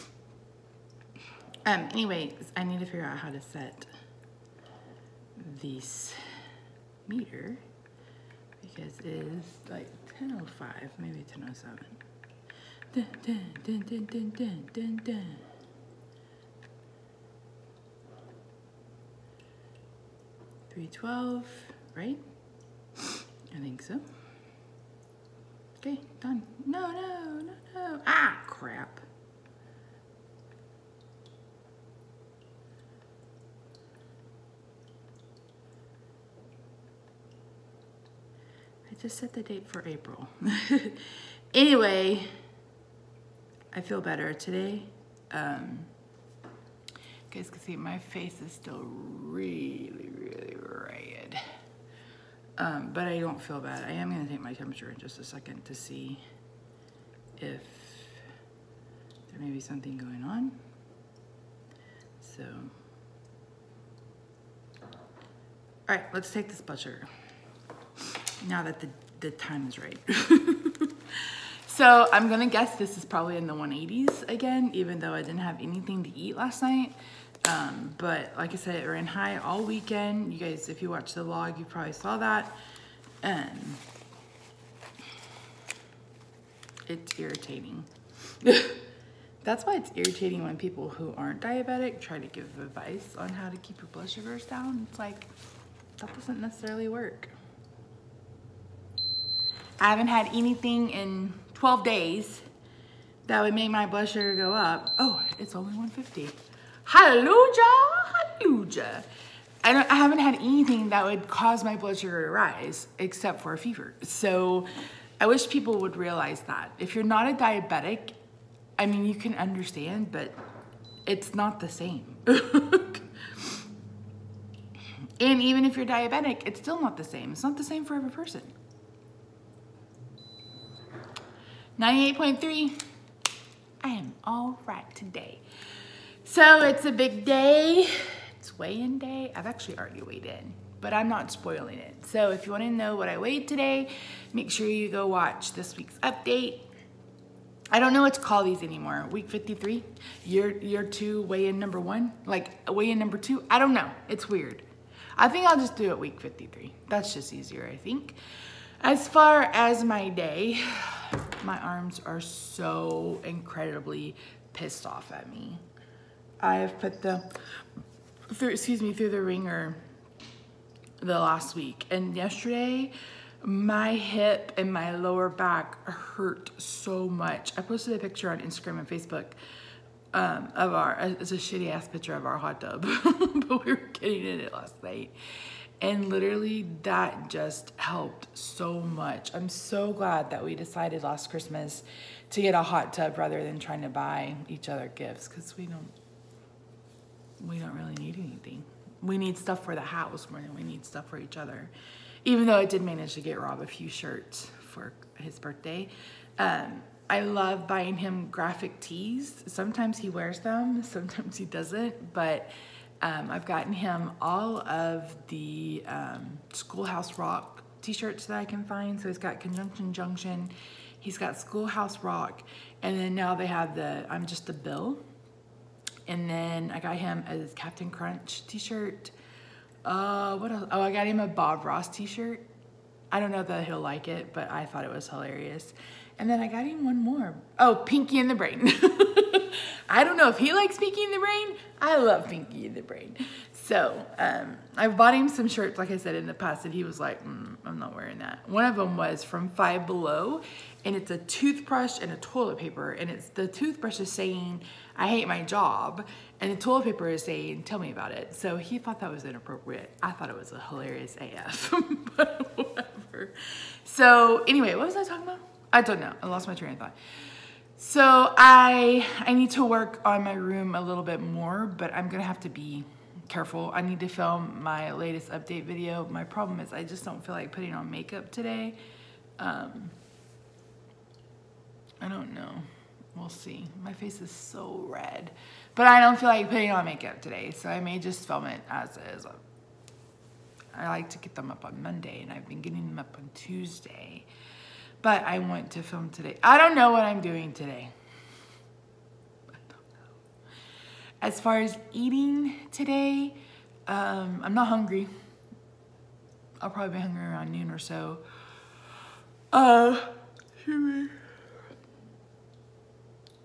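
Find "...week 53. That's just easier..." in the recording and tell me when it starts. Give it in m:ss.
2:35.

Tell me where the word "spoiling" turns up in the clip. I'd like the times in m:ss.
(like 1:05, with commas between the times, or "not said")
2:21.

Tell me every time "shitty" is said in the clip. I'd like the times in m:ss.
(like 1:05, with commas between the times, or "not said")
3:01.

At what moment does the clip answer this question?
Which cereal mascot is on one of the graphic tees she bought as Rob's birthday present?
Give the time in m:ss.
3:47.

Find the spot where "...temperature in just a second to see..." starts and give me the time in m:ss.
0:54.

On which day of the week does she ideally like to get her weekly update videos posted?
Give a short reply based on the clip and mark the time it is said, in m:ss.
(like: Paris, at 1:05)
Monday, at 4:51.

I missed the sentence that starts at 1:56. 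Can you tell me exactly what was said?
If you're not a diabetic, I mean, you can understand, but it's not the same.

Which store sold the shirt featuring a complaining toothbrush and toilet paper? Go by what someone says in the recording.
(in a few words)
Five Below.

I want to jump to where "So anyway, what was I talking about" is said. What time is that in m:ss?
4:23.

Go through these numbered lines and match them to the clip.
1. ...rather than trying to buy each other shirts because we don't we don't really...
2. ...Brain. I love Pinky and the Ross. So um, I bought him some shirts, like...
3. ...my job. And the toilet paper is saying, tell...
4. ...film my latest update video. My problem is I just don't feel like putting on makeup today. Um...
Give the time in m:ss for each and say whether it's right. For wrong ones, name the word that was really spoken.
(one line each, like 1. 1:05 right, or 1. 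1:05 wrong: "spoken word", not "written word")
1. 3:13 wrong: "gifts", not "shirts"
2. 4:01 wrong: "Brain", not "Ross"
3. 4:15 right
4. 4:34 right.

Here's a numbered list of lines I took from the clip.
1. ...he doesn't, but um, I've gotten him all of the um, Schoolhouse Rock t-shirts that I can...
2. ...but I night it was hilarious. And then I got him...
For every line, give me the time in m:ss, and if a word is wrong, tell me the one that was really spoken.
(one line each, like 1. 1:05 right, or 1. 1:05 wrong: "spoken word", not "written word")
1. 3:31 right
2. 3:54 wrong: "thought", not "night".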